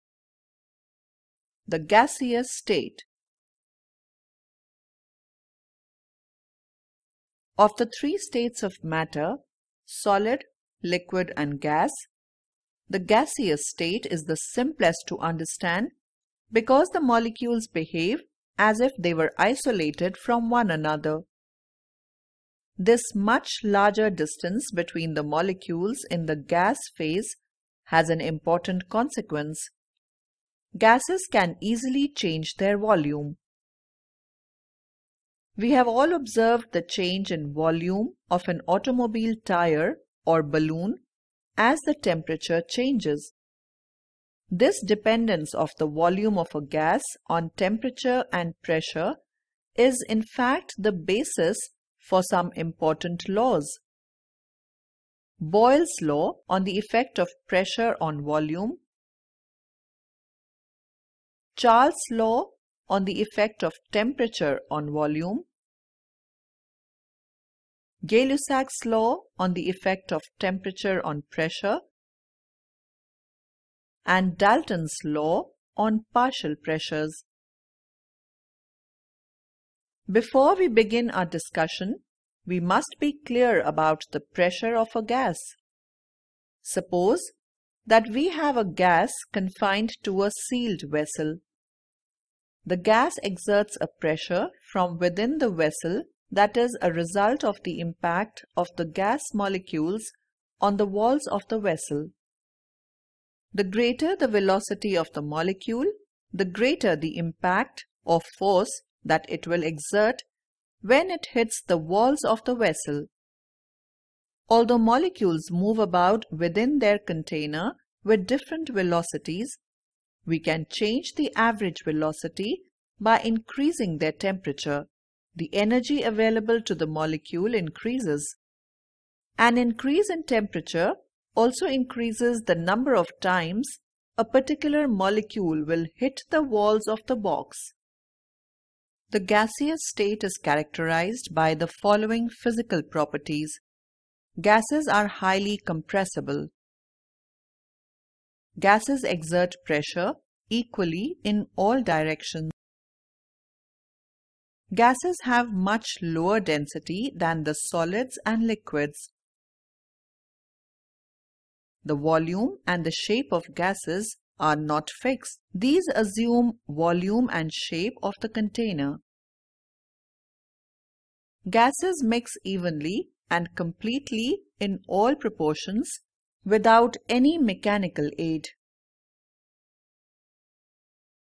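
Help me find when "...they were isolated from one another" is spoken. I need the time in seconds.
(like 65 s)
18 s.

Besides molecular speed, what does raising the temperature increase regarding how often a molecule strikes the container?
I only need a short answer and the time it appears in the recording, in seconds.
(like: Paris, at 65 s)
the number of times, at 132 s.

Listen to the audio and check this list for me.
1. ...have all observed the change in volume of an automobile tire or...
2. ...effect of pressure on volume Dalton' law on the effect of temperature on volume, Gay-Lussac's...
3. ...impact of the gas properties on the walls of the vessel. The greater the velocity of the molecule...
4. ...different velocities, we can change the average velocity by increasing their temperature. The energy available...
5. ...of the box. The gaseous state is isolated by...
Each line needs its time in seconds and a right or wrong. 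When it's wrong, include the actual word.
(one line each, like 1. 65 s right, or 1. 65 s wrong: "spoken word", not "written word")
1. 35 s right
2. 56 s wrong: "Charles", not "Dalton"
3. 97 s wrong: "molecules", not "properties"
4. 118 s right
5. 136 s wrong: "characterized", not "isolated".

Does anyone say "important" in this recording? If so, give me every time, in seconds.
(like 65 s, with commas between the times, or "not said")
28 s, 52 s.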